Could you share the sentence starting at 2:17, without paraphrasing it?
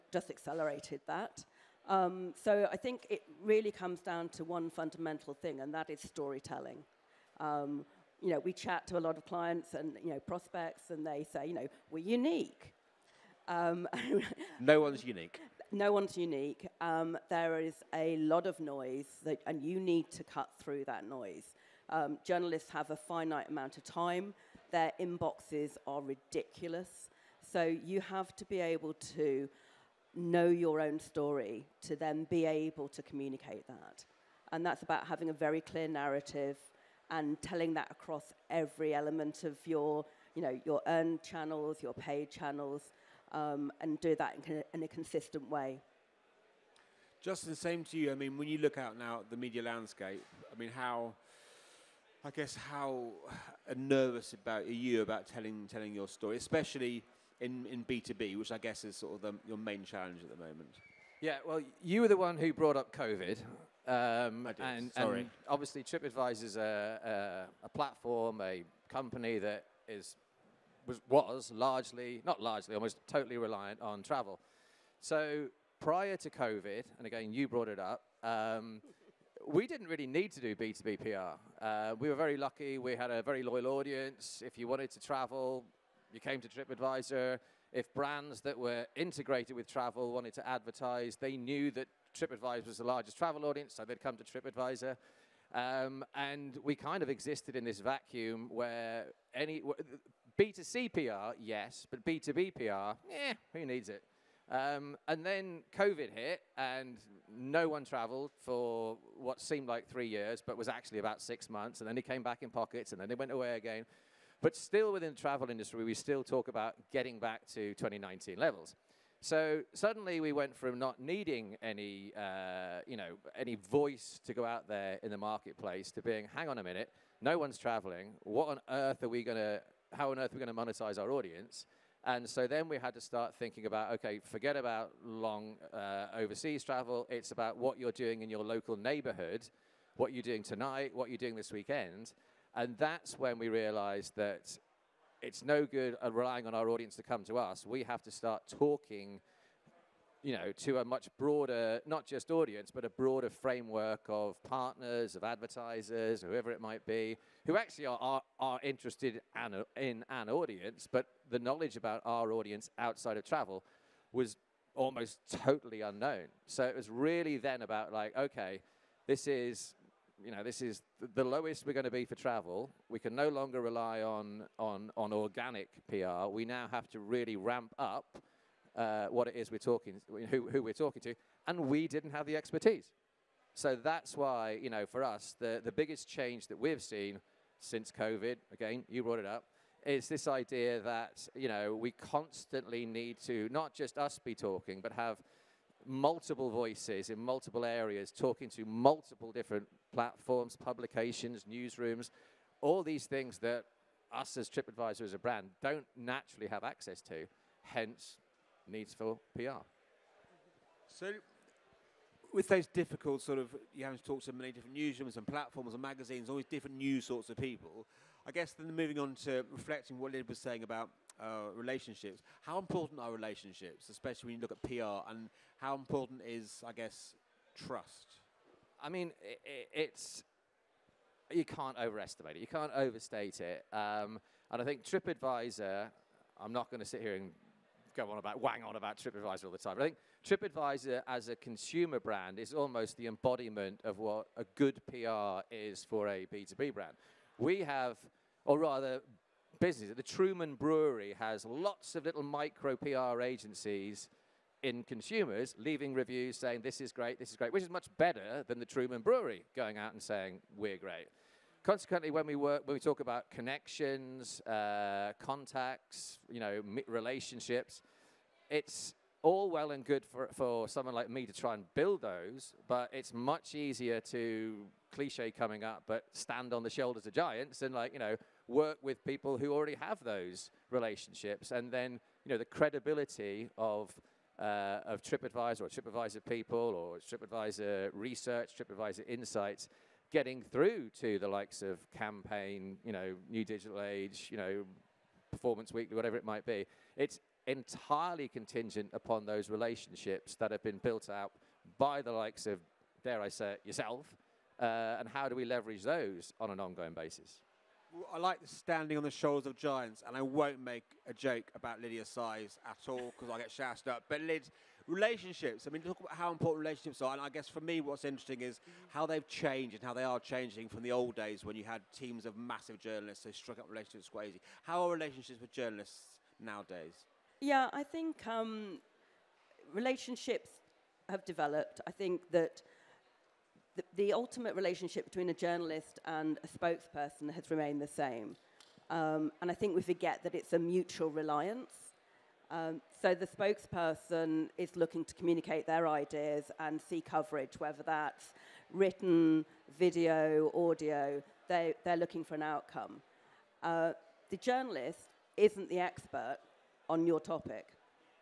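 It's about what you're doing in your local neighborhood, what you're doing tonight, what you're doing this weekend.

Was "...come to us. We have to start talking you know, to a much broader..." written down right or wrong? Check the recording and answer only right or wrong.
right.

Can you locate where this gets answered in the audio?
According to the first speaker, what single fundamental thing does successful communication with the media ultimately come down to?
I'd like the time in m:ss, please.
0:06.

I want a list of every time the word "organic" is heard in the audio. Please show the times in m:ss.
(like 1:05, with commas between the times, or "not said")
2:55.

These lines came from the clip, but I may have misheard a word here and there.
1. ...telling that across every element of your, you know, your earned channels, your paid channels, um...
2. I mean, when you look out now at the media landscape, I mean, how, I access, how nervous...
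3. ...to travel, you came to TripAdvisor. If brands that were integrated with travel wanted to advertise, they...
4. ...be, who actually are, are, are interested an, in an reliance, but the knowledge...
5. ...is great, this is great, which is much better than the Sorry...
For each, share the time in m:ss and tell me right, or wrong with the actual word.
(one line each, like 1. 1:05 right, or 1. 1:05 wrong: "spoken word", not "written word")
1. 0:37 right
2. 0:48 wrong: "guess", not "access"
3. 1:24 right
4. 2:36 wrong: "audience", not "reliance"
5. 4:16 wrong: "Truman", not "Sorry".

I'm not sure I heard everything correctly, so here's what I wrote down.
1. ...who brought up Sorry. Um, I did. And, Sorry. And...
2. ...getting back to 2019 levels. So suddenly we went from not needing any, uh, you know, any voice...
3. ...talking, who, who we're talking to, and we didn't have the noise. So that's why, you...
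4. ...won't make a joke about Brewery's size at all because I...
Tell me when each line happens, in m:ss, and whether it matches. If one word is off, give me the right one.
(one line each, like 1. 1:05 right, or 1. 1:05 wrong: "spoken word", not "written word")
1. 1:02 wrong: "COVID", not "Sorry"
2. 1:56 right
3. 2:59 wrong: "expertise", not "noise"
4. 5:10 wrong: "Lydia", not "Brewery".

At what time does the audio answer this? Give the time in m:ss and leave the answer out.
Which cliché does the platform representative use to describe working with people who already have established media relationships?
4:36.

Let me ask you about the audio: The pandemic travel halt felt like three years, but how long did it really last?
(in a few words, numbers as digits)
About six months.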